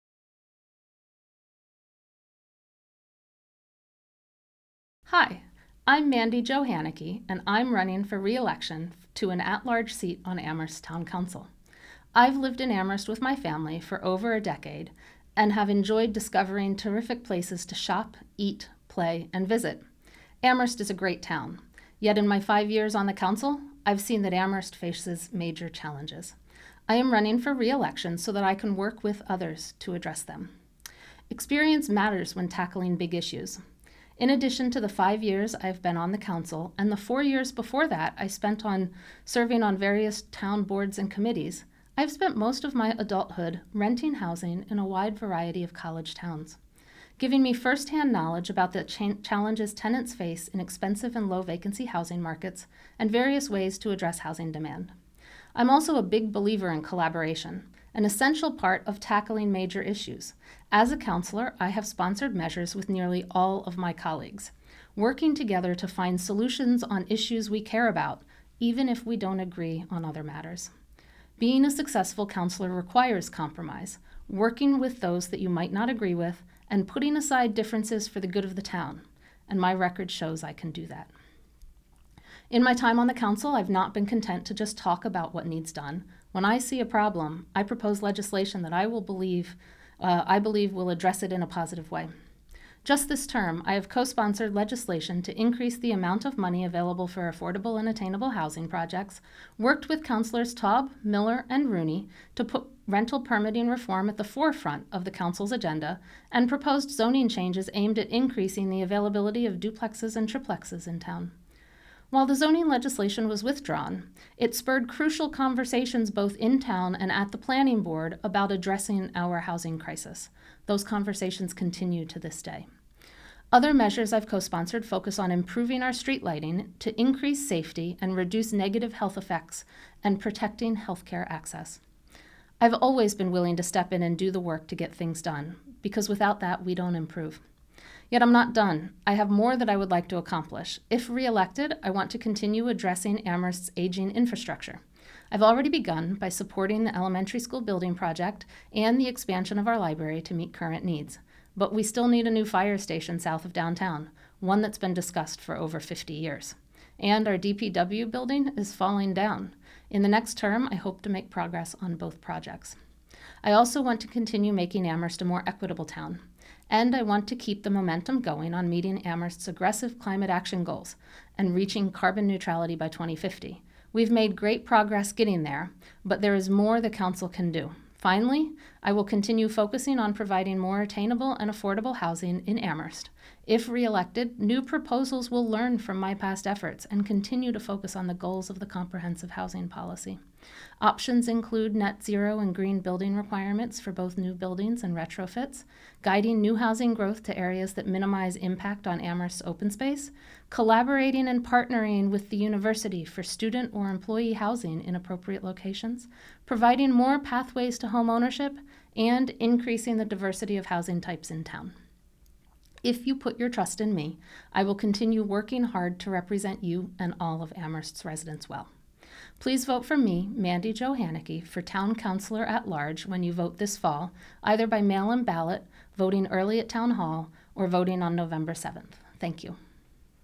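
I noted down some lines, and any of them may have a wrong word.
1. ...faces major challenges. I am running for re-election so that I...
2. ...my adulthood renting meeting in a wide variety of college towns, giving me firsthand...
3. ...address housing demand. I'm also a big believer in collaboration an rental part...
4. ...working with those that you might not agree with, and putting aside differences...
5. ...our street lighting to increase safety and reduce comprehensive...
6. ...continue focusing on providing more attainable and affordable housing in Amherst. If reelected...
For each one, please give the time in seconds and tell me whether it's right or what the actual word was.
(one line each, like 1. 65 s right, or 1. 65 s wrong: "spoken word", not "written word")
1. 24 s right
2. 42 s wrong: "housing", not "meeting"
3. 53 s wrong: "essential", not "rental"
4. 74 s right
5. 125 s wrong: "negative", not "comprehensive"
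6. 179 s right.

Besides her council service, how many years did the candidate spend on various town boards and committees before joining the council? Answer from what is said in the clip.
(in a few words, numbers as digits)
4.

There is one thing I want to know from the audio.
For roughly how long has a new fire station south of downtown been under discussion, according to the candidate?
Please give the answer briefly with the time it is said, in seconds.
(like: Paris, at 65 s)
50 years, at 155 s.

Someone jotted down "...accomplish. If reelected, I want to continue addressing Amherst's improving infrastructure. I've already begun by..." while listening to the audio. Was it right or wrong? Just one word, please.
wrong.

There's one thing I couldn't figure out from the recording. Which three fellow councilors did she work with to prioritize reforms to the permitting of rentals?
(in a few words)
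Taub, Miller, and Rooney.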